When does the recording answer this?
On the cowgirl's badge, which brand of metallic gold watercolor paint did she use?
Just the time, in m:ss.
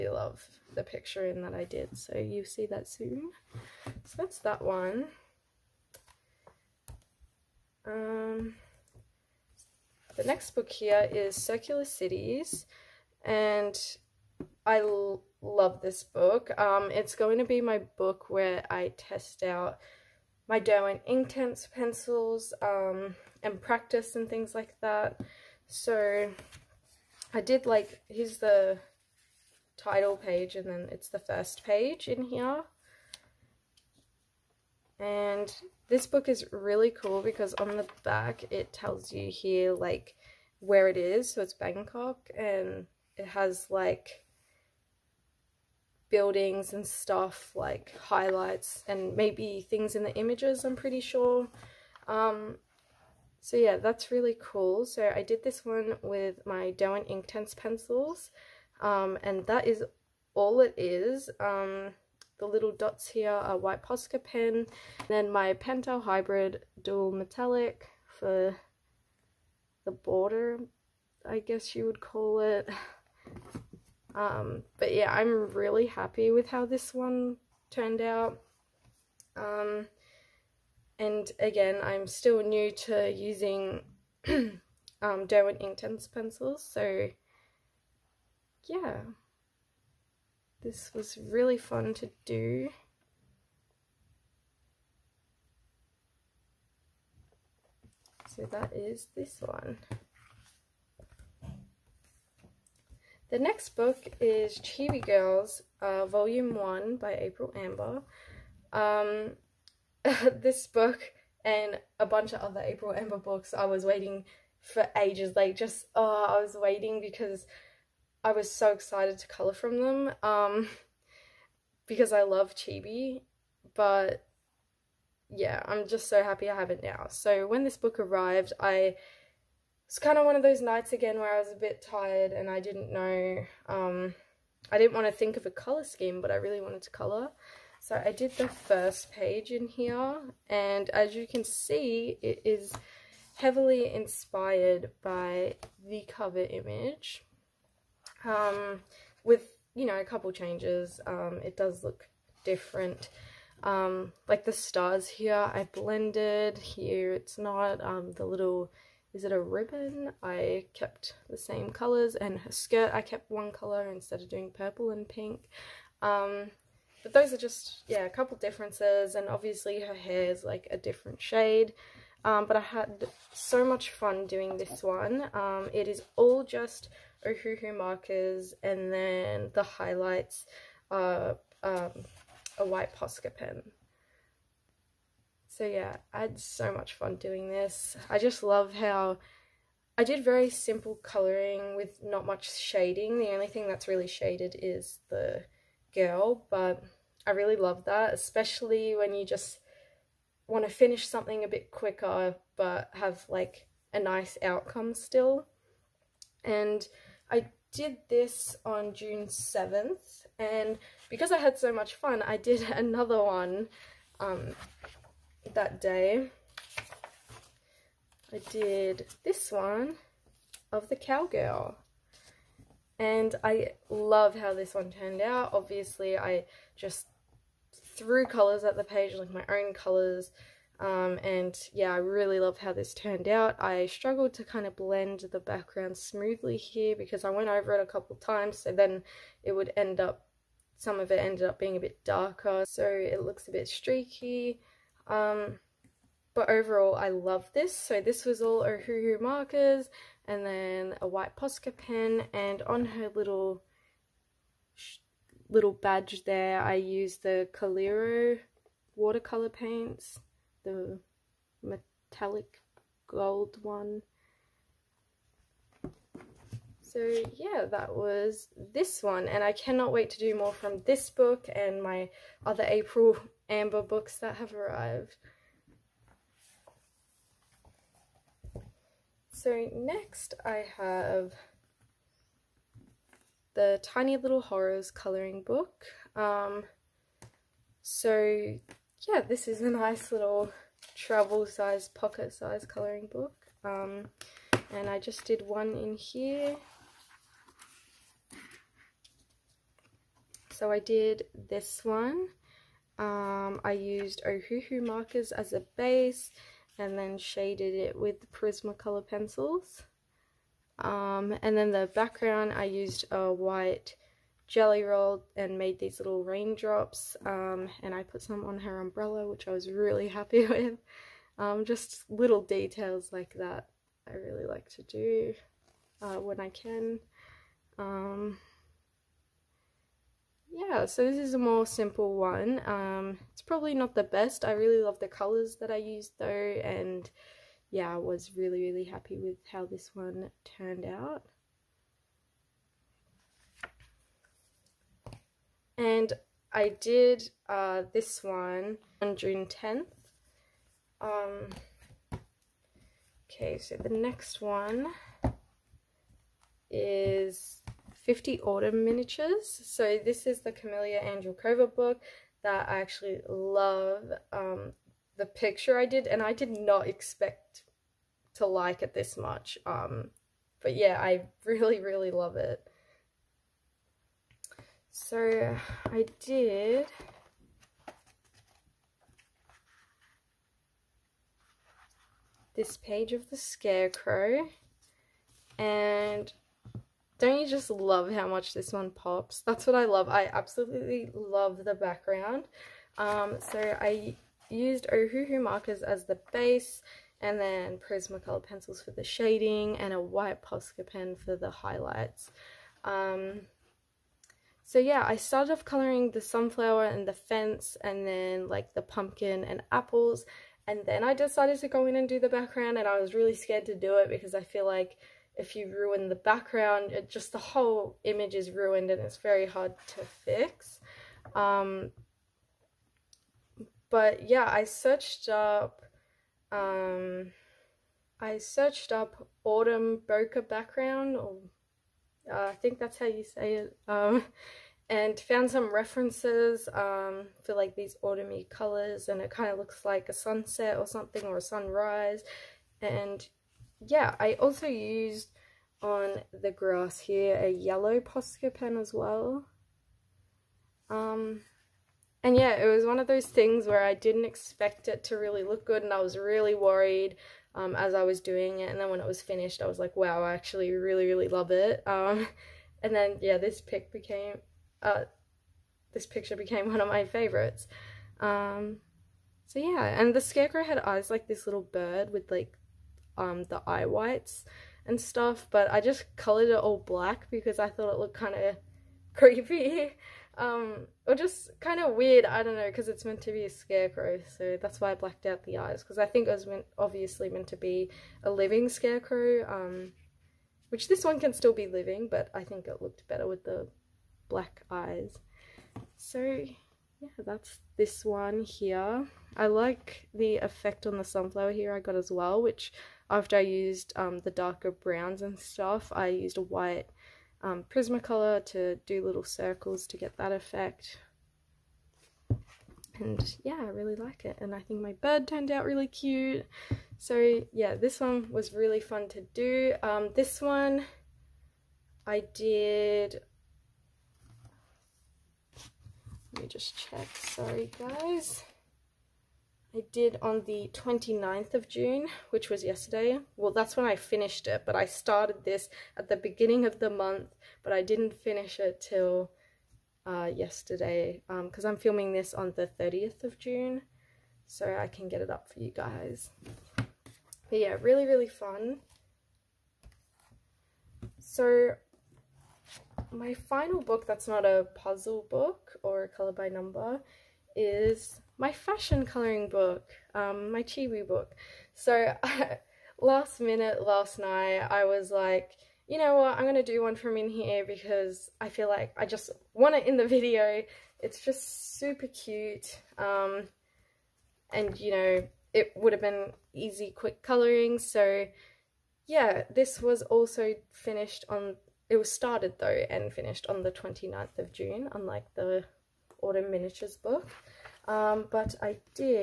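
4:17.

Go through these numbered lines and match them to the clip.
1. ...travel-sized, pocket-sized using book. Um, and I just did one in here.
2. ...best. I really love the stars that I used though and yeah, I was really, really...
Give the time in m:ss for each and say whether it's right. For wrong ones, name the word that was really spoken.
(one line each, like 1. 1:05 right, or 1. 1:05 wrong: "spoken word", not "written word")
1. 4:50 wrong: "colouring", not "using"
2. 5:34 wrong: "colours", not "stars".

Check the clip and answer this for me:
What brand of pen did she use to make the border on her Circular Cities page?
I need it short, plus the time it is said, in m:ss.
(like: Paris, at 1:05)
Pentel Hybrid Dual Metallic, at 1:05.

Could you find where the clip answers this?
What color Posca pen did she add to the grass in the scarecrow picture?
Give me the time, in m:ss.
7:27.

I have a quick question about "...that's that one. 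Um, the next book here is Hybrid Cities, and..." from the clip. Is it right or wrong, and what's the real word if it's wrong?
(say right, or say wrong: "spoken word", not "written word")
wrong: "Circular", not "Hybrid".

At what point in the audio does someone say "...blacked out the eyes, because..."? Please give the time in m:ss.
8:04.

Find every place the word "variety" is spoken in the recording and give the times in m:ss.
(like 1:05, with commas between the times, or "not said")
not said.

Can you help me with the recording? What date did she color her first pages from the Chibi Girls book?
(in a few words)
June 7.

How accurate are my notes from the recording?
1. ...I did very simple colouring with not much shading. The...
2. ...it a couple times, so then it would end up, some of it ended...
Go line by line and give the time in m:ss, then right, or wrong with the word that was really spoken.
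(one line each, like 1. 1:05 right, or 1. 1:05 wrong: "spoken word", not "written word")
1. 3:09 right
2. 3:57 right.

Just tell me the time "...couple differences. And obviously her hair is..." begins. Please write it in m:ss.
2:48.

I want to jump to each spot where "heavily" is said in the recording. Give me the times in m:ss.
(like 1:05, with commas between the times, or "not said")
2:23.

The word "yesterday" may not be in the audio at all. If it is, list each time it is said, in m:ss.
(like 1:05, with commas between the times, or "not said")
8:52, 9:00.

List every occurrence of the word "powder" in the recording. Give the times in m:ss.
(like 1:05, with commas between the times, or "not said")
not said.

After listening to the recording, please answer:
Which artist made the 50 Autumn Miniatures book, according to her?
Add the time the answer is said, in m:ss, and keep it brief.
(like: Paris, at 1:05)
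Camellia Andrewkova, at 6:00.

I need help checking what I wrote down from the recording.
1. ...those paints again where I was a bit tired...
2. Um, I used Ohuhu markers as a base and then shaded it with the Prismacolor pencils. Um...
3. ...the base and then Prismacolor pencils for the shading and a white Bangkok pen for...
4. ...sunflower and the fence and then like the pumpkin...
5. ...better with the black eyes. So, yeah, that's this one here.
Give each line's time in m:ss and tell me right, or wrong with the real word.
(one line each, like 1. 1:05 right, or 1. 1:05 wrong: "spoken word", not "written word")
1. 2:10 wrong: "nights", not "paints"
2. 5:02 right
3. 6:36 wrong: "Posca", not "Bangkok"
4. 6:46 right
5. 8:13 right.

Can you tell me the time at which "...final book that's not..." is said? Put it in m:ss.
9:13.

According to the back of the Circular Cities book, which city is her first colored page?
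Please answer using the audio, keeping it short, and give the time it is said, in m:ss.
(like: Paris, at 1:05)
Bangkok, at 0:41.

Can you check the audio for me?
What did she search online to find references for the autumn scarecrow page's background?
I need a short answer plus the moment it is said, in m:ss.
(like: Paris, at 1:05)
autumn bokeh background, at 7:09.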